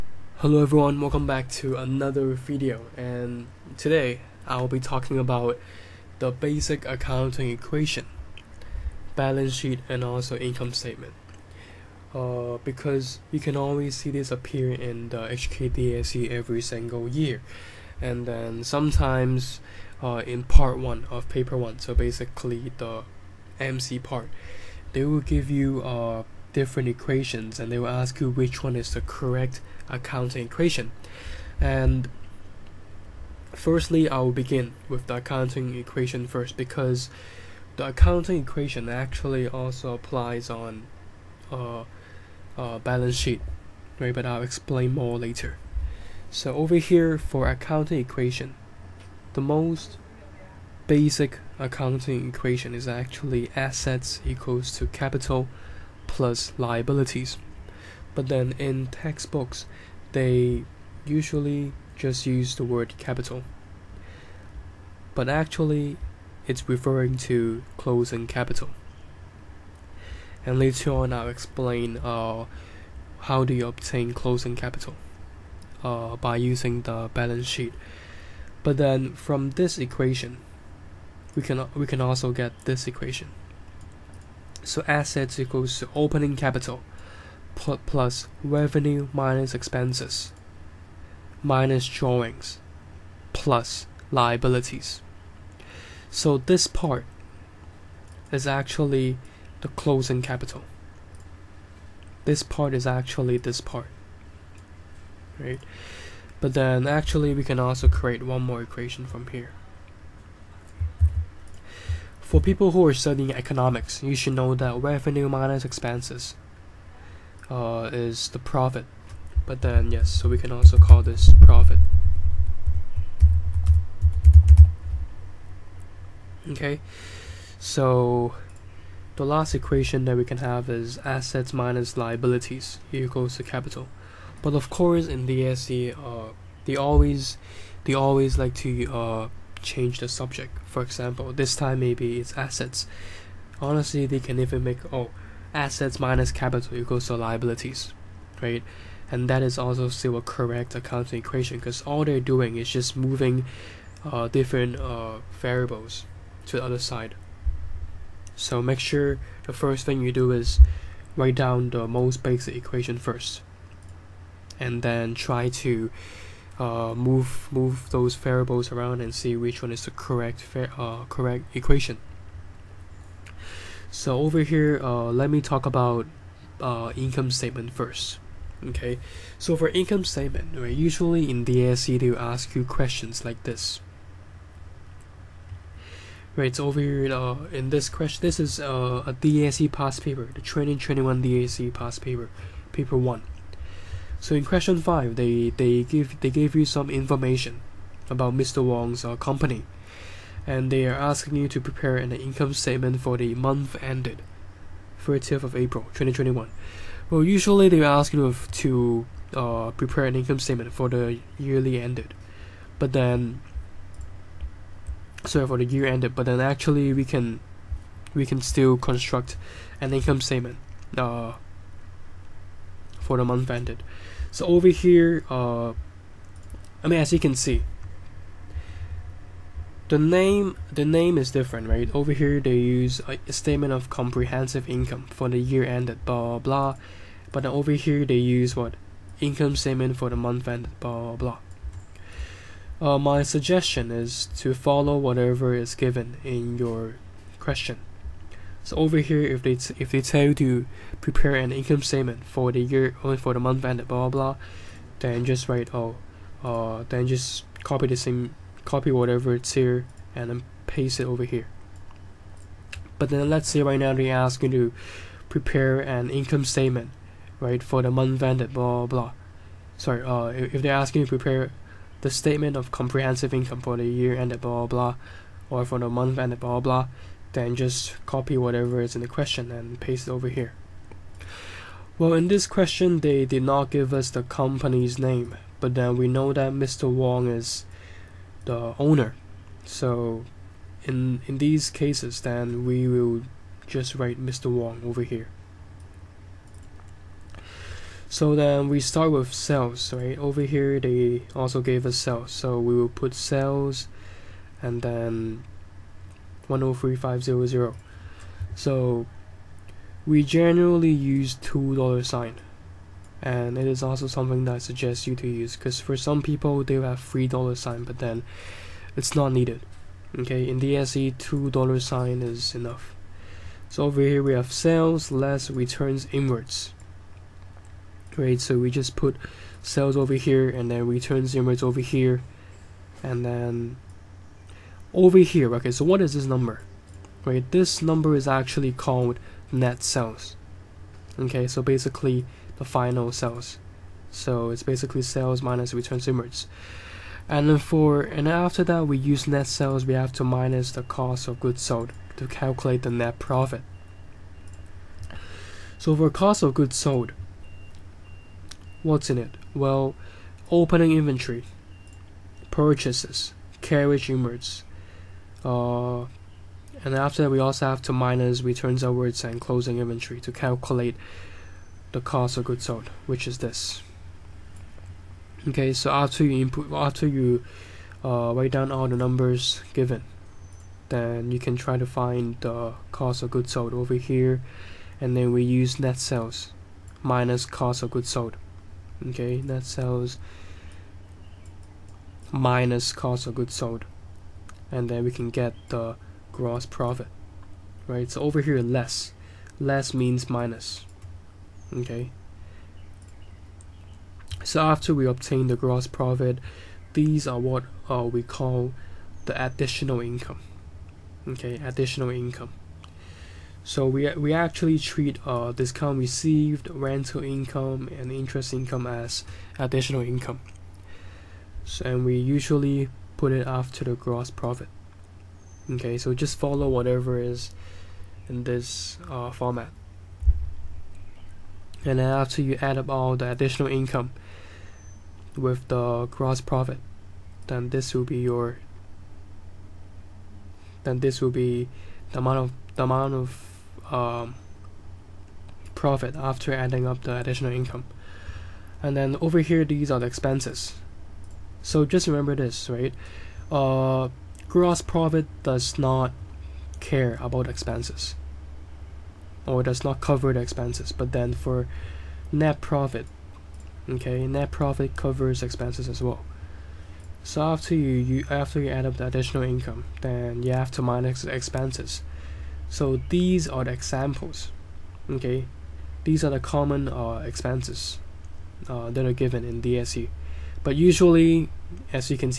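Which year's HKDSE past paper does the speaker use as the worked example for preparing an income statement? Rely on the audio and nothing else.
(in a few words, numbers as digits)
2021.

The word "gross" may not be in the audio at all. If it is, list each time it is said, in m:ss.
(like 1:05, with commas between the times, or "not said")
6:36, 6:45, 7:03, 7:16, 7:34.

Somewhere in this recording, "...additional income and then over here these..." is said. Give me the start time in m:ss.
7:27.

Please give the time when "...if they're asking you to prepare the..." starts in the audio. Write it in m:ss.
4:30.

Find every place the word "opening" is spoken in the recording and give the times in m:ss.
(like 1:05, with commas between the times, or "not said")
1:25, 6:00.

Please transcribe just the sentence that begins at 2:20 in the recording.
For example, this time maybe it's assets.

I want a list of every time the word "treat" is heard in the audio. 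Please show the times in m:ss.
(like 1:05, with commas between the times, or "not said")
6:54.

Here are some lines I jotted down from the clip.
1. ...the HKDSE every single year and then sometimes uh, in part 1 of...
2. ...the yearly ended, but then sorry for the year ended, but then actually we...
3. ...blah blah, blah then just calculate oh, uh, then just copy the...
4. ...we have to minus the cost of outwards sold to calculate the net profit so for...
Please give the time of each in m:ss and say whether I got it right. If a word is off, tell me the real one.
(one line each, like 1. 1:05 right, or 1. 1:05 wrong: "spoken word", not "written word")
1. 0:15 right
2. 3:30 right
3. 4:13 wrong: "write", not "calculate"
4. 5:49 wrong: "goods", not "outwards".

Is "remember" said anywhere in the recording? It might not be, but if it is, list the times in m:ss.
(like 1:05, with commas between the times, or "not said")
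7:32.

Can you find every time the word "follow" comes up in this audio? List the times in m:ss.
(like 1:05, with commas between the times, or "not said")
4:04, 7:06.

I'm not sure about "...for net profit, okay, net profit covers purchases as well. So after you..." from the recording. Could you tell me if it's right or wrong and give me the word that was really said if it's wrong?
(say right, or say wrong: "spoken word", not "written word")
wrong: "expenses", not "purchases".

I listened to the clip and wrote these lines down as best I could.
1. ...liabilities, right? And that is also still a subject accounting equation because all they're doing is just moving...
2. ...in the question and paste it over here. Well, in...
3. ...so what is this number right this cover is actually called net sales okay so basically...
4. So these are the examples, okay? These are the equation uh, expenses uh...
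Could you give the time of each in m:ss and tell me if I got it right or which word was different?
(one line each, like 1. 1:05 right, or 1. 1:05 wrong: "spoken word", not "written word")
1. 2:27 wrong: "correct", not "subject"
2. 4:38 right
3. 5:35 wrong: "number", not "cover"
4. 7:52 wrong: "common", not "equation".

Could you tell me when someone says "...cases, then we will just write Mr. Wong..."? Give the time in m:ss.
4:51.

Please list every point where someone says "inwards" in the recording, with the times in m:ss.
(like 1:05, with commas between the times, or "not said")
5:26, 5:31, 5:46, 6:04.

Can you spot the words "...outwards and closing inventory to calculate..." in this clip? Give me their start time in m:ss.
6:08.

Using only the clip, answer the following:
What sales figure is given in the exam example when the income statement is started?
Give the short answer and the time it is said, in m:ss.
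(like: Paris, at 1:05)
103500, at 5:06.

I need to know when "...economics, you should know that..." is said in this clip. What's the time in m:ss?
1:53.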